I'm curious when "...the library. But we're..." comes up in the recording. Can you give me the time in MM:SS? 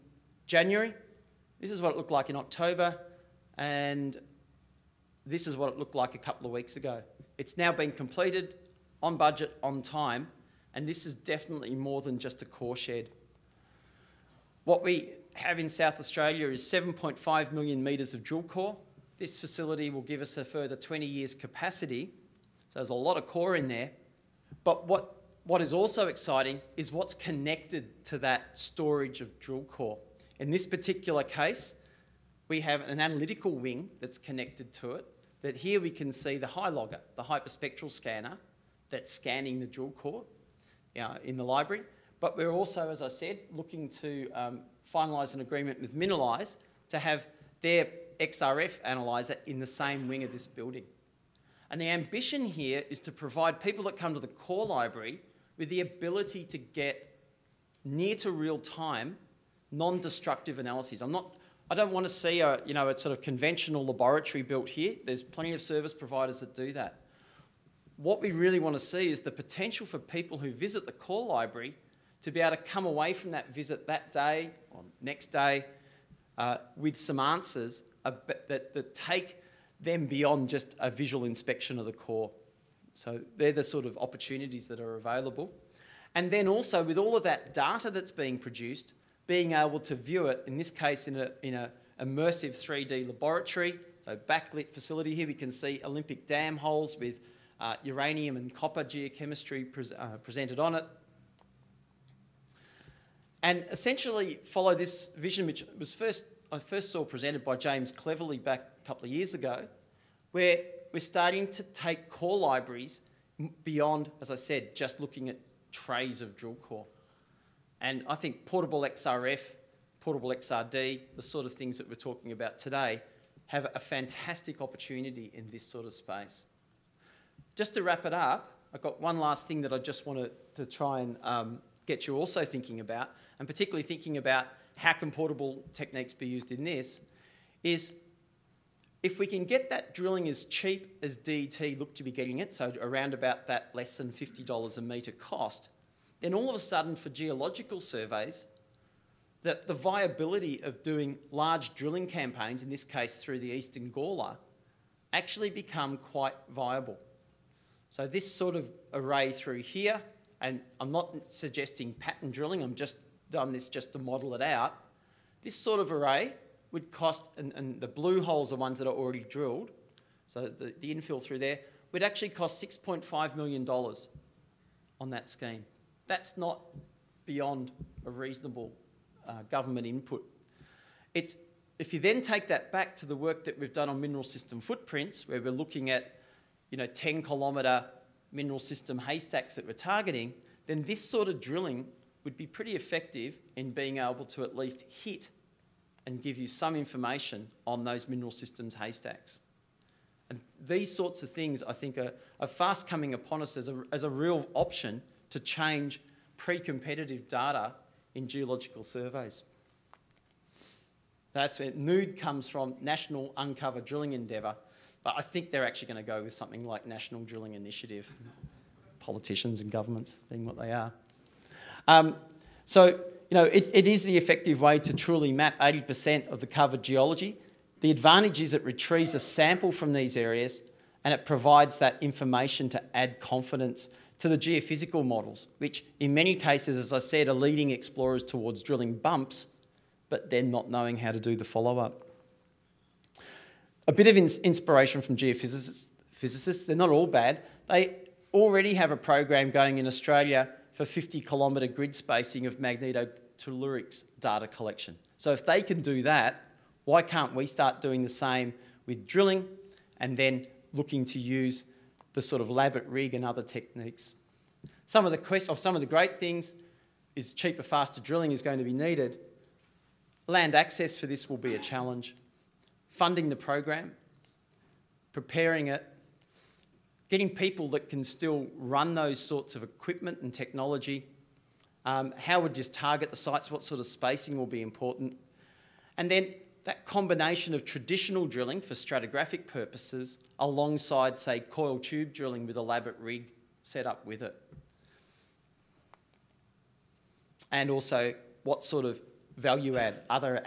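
00:41.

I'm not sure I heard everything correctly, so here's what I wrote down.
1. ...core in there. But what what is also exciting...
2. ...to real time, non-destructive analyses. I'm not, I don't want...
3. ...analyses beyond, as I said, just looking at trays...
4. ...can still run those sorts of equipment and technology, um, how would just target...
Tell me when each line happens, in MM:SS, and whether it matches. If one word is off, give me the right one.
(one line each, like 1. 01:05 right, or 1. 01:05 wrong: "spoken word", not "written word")
1. 00:23 right
2. 00:58 right
3. 01:52 wrong: "libraries", not "analyses"
4. 04:37 right.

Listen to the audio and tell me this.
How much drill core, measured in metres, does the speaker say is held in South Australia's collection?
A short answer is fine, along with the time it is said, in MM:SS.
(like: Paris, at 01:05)
7.5 million metres, at 00:16.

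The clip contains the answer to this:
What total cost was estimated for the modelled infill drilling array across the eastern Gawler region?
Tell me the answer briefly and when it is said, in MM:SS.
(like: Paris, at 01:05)
$6.5 million, at 02:52.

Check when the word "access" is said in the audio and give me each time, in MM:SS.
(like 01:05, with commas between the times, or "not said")
04:30.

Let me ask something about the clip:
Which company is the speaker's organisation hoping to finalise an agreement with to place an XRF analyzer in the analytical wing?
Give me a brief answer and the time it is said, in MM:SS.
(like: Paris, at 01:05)
Minalyze, at 00:45.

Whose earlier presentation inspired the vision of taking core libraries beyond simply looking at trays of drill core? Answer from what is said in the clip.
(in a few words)
James Cleverley.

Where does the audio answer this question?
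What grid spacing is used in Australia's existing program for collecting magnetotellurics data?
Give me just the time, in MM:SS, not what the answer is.
04:10.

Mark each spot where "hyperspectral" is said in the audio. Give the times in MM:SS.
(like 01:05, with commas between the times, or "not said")
00:37.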